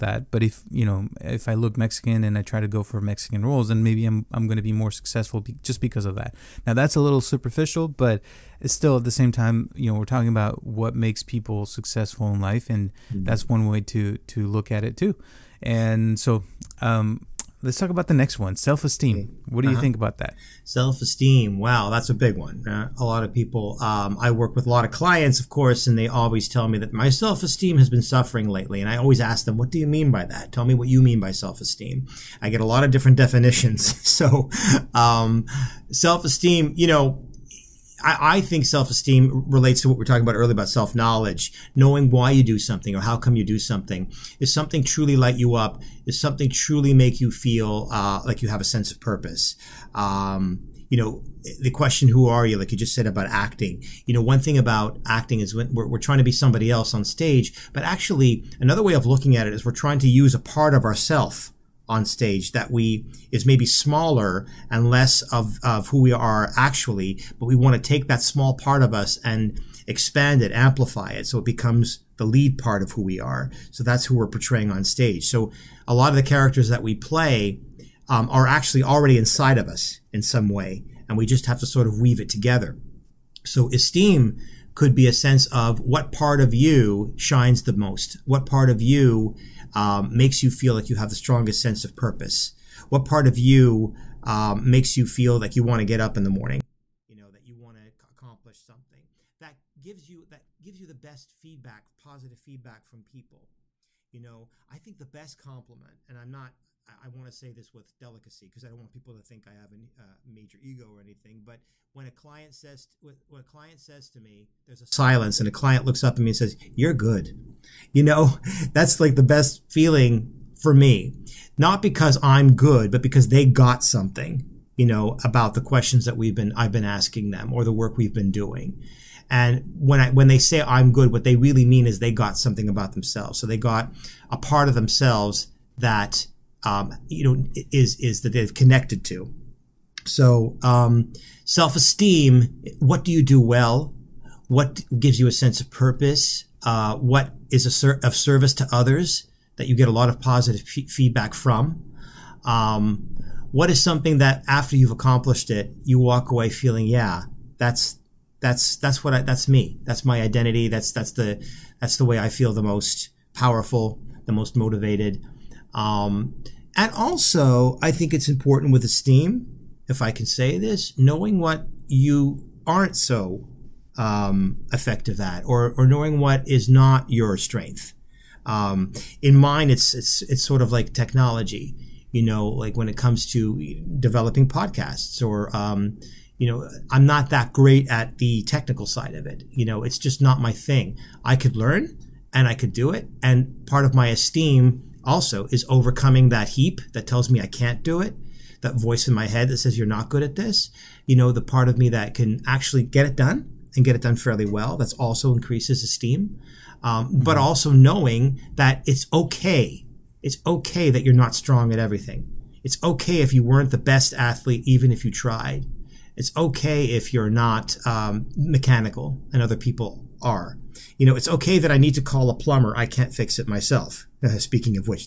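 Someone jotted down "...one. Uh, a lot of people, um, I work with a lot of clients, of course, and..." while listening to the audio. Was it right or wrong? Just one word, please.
right.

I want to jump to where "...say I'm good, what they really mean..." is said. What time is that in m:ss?
2:10.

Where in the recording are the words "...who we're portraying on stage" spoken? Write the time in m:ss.
1:14.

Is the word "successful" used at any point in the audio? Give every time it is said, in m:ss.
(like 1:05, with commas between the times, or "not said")
0:04, 0:11.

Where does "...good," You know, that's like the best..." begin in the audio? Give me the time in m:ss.
1:56.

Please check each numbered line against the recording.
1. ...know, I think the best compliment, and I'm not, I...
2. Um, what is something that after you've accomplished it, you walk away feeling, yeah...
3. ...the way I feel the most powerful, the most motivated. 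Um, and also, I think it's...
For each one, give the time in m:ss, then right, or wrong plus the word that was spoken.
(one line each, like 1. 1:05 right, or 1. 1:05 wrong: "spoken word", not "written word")
1. 1:44 right
2. 2:32 right
3. 2:41 right.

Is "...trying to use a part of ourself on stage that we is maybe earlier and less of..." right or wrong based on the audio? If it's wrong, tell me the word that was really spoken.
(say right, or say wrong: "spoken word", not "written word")
wrong: "smaller", not "earlier".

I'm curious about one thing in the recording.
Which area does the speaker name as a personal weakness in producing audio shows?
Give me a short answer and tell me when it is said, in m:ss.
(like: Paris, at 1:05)
technology, at 3:00.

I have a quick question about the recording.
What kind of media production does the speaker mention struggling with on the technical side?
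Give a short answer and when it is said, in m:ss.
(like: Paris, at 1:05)
podcasts, at 3:04.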